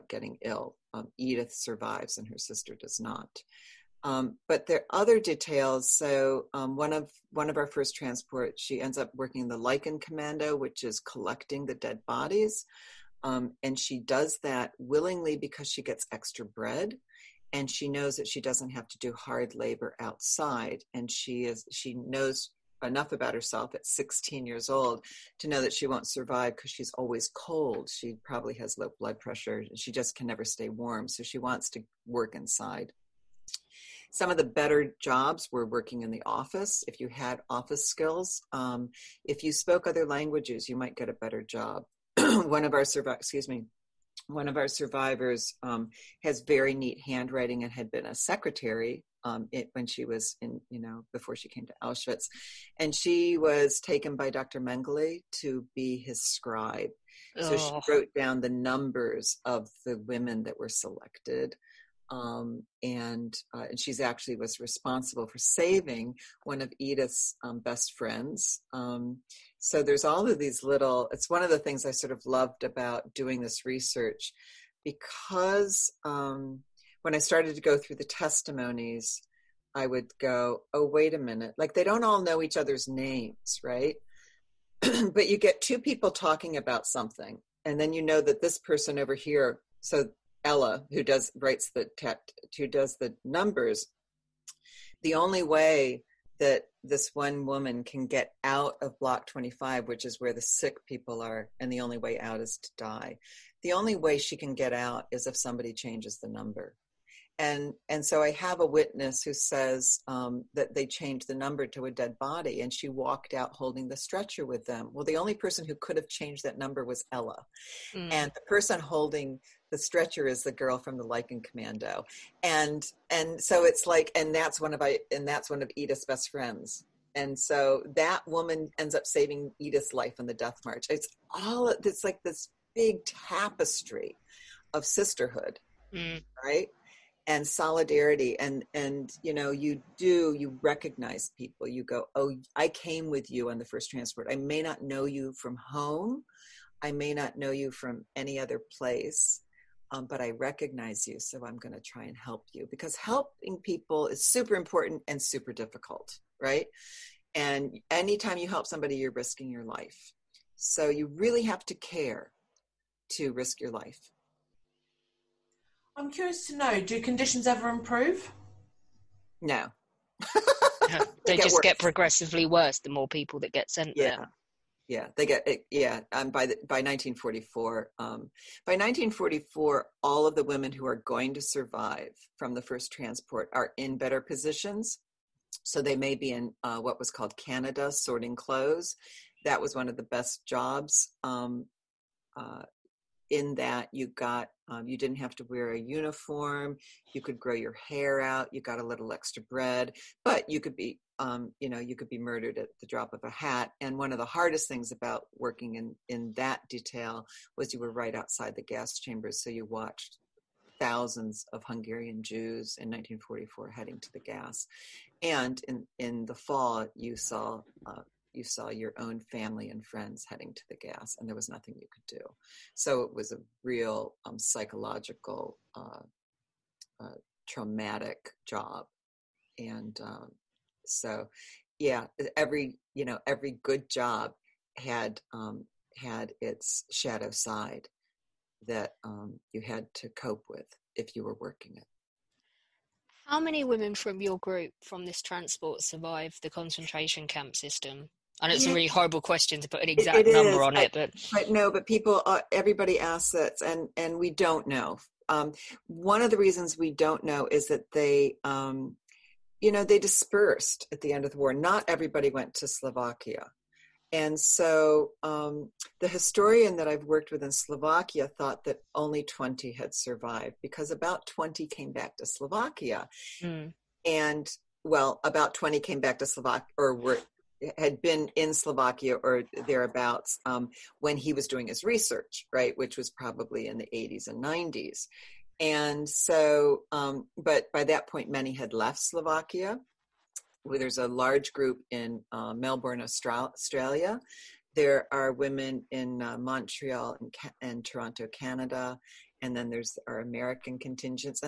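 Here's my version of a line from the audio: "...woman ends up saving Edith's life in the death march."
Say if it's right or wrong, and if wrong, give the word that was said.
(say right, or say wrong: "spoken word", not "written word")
right.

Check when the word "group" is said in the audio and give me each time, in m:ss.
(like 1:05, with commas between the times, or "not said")
4:04, 4:51.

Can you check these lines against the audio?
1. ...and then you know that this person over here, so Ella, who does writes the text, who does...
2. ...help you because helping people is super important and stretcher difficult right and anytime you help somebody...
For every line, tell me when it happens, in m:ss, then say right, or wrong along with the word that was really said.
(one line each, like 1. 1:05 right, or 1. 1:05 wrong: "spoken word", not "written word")
1. 1:27 right
2. 2:32 wrong: "super", not "stretcher".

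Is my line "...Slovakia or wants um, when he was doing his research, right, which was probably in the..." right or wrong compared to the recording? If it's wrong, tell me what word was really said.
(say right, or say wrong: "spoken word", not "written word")
wrong: "thereabouts", not "wants".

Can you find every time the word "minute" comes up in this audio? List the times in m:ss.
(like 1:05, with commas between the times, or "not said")
1:21.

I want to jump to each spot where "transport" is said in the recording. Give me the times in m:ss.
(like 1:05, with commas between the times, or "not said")
0:07, 2:23, 3:02, 4:05.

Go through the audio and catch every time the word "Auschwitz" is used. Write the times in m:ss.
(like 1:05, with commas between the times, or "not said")
0:51.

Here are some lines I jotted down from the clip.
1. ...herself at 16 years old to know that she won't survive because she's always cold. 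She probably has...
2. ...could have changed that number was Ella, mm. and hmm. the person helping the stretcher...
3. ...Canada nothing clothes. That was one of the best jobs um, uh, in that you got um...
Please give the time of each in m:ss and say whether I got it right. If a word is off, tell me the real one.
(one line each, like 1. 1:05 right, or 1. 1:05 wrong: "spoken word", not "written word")
1. 0:23 right
2. 1:55 wrong: "holding", not "helping"
3. 3:07 wrong: "sorting", not "nothing".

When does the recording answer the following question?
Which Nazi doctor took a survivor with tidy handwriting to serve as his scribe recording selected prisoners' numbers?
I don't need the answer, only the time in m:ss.
0:54.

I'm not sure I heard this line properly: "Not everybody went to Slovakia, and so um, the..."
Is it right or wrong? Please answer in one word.
right.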